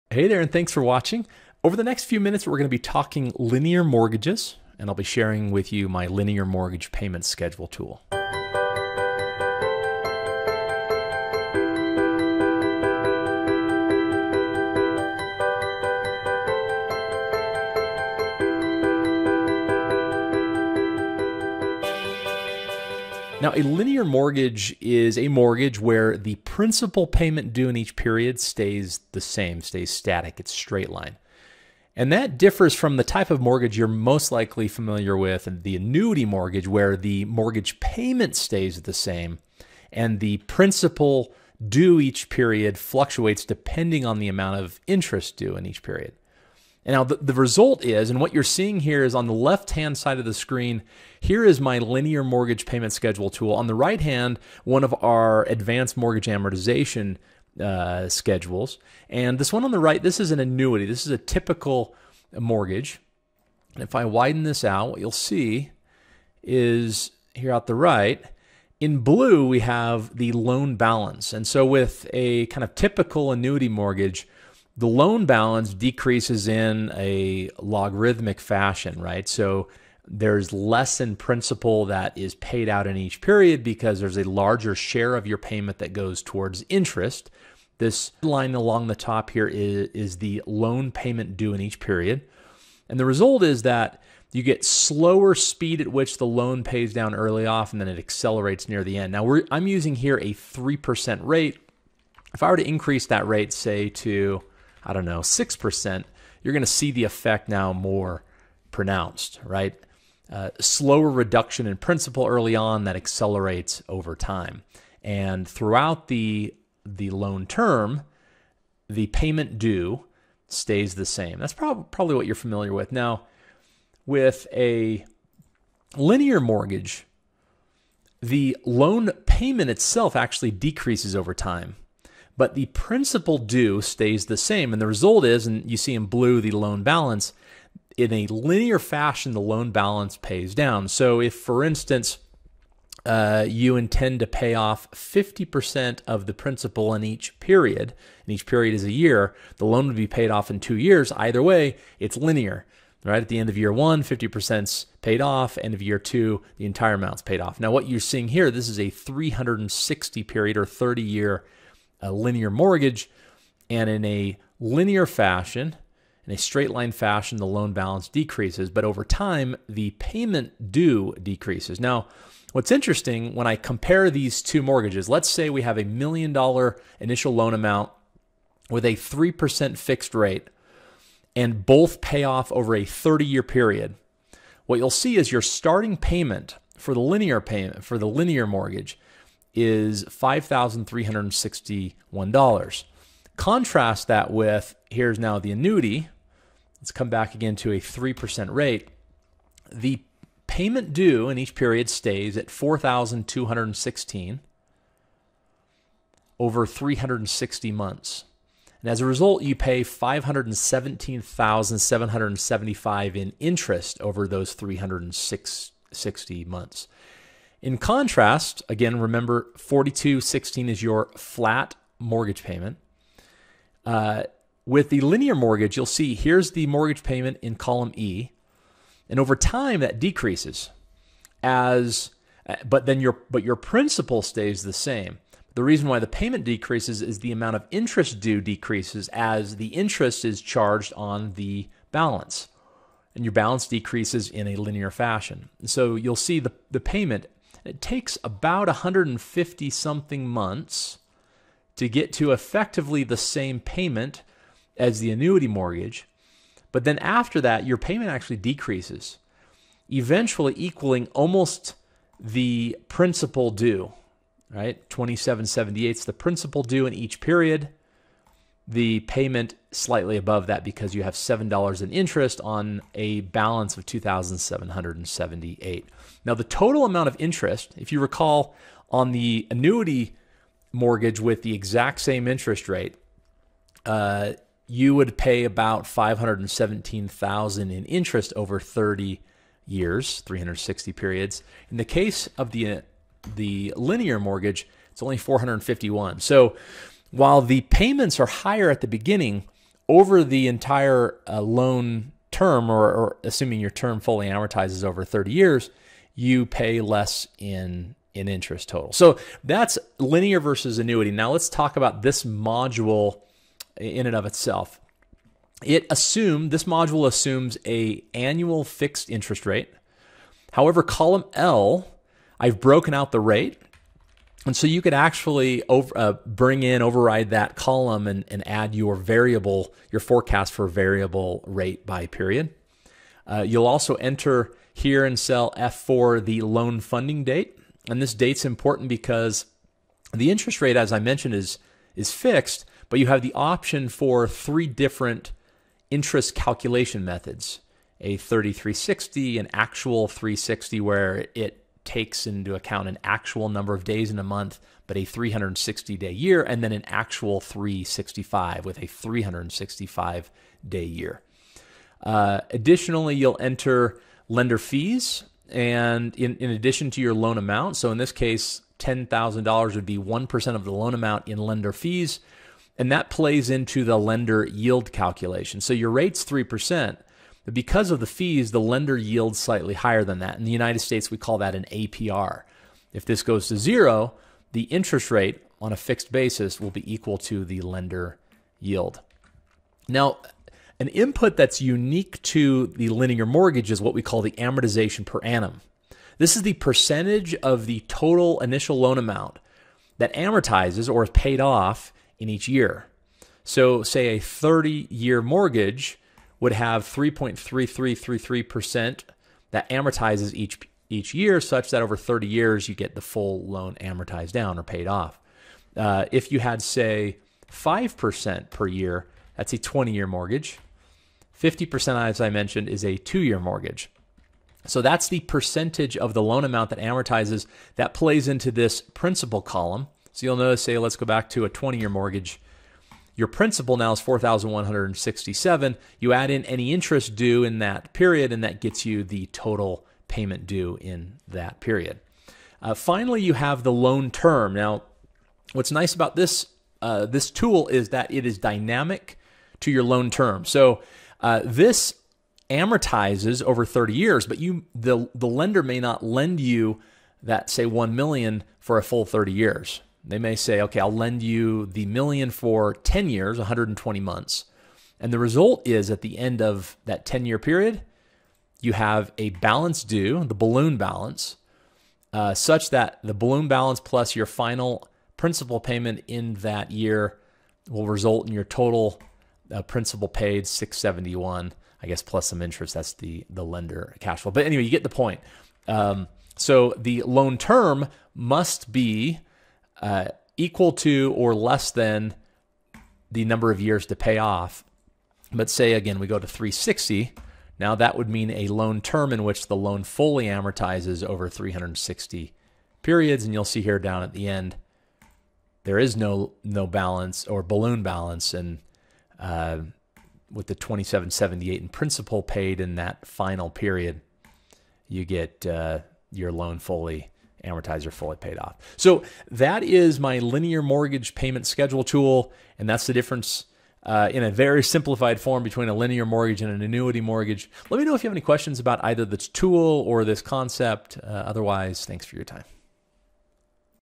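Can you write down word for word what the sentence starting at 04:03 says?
And your balance decreases in a linear fashion.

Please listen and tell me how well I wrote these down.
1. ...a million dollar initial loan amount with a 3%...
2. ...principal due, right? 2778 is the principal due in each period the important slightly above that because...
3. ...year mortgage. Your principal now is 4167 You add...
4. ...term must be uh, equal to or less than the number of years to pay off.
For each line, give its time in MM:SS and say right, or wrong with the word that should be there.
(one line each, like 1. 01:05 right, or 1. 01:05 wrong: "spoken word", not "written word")
1. 02:55 right
2. 04:22 wrong: "payment", not "important"
3. 07:11 right
4. 08:07 right.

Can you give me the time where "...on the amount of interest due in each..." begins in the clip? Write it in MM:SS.
00:44.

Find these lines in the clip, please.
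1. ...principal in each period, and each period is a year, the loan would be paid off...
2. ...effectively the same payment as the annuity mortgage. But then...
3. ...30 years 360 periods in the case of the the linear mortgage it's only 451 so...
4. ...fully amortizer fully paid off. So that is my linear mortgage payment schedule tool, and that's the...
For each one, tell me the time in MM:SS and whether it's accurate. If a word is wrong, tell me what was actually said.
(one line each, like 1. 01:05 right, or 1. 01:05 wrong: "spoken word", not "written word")
1. 02:26 right
2. 04:12 right
3. 04:48 right
4. 08:36 right.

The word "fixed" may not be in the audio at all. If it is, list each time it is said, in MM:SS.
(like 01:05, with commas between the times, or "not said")
02:59, 05:18, 05:42, 06:25.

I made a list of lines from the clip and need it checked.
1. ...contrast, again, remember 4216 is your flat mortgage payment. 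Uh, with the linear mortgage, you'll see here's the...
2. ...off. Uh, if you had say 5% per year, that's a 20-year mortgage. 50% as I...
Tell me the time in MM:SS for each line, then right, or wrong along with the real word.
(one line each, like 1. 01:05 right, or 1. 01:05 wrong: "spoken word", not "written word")
1. 03:37 right
2. 06:54 right.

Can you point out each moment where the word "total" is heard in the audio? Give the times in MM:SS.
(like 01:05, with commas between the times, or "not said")
04:36, 05:08, 06:37, 07:19, 07:58.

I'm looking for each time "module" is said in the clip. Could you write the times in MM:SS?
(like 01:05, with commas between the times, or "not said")
05:12, 05:16.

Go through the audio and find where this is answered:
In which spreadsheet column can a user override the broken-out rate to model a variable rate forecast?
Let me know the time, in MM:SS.
05:20.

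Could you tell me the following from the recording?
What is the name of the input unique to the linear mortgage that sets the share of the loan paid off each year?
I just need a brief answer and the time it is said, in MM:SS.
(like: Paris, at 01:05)
Amortization per annum, at 06:34.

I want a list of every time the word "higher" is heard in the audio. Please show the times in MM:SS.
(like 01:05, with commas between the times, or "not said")
04:58, 06:19.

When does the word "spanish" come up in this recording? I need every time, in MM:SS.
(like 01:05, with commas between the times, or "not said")
not said.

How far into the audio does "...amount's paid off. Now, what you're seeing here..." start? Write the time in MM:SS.
02:36.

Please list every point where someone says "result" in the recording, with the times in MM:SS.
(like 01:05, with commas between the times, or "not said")
00:47, 01:33, 02:14, 07:45, 07:57.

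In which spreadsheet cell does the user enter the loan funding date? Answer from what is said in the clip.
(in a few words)
F4.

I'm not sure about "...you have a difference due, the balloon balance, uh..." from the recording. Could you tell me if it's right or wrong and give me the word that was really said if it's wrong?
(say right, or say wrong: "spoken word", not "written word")
wrong: "balance", not "difference".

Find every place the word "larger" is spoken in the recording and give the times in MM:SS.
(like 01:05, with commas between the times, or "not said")
01:24.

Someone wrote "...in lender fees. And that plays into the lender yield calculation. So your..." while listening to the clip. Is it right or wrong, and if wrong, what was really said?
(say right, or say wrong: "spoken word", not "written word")
right.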